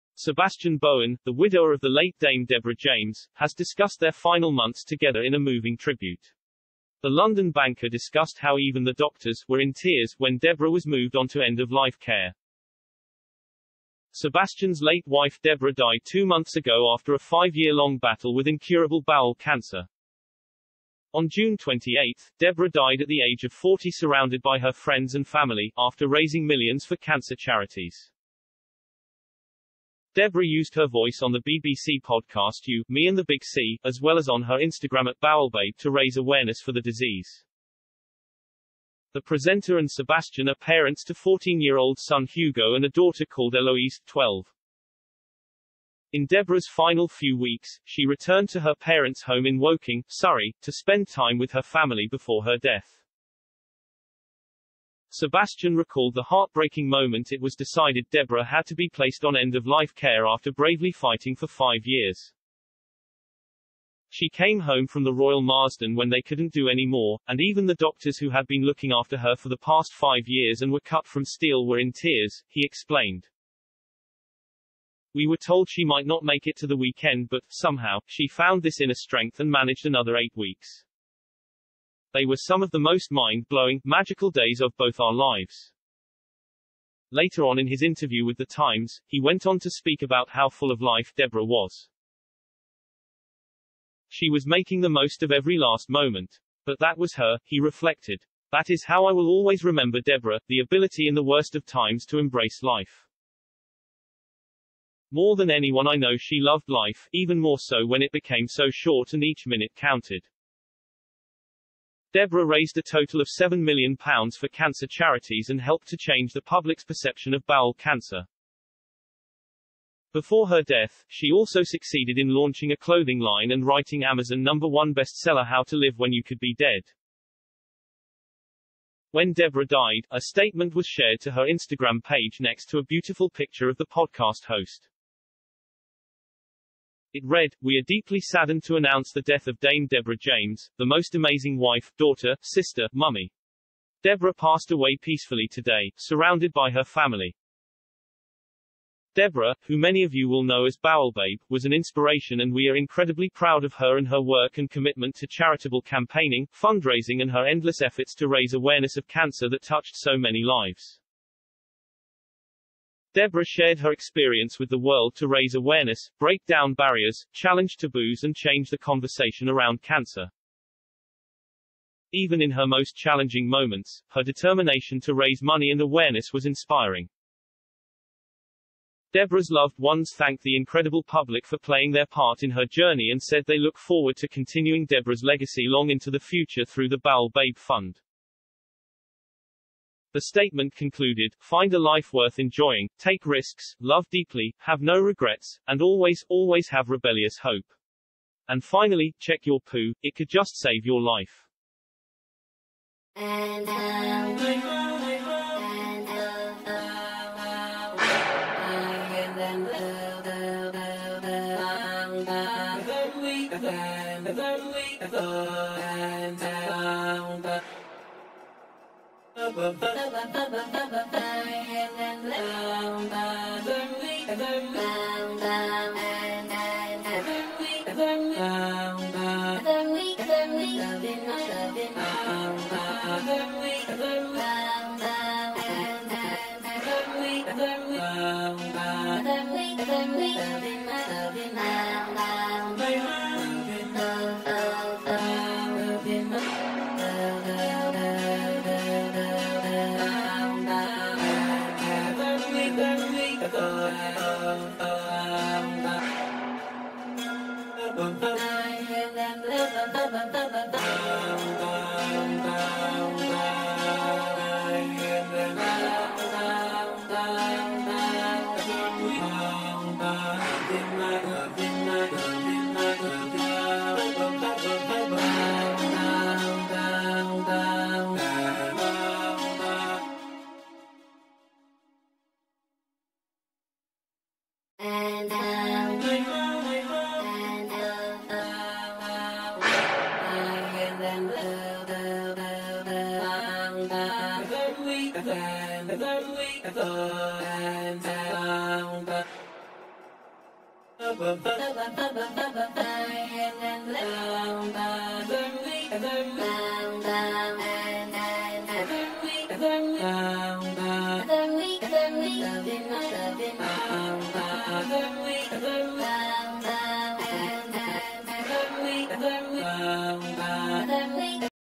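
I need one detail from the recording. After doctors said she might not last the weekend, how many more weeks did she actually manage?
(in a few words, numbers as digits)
8.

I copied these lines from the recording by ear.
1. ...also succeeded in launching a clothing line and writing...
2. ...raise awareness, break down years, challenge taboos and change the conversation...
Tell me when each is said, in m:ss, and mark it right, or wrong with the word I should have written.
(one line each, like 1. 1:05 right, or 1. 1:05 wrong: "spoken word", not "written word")
1. 2:01 right
2. 2:45 wrong: "barriers", not "years".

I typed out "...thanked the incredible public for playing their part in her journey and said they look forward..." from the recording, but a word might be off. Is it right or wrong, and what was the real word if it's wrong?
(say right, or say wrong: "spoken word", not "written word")
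right.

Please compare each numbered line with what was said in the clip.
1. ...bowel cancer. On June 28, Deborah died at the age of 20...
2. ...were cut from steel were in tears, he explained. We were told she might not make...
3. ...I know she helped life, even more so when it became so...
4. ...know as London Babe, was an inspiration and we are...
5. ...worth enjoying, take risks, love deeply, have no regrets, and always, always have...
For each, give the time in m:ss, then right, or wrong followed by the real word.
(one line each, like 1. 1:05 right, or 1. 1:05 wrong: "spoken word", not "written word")
1. 0:19 wrong: "40", not "20"
2. 1:10 right
3. 1:45 wrong: "loved", not "helped"
4. 2:30 wrong: "Bowel", not "London"
5. 3:12 right.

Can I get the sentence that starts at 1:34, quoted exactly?
She was making the most of every last moment.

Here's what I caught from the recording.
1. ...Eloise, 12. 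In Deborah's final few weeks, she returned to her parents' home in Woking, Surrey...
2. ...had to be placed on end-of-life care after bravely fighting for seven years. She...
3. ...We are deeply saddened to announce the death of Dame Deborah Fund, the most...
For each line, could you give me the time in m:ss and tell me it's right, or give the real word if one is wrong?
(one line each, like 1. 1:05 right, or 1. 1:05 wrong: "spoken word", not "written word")
1. 0:43 right
2. 0:58 wrong: "five", not "seven"
3. 2:17 wrong: "James", not "Fund".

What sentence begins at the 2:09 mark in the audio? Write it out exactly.
When Deborah died, a statement was shared to her Instagram page next to a beautiful picture of the podcast host.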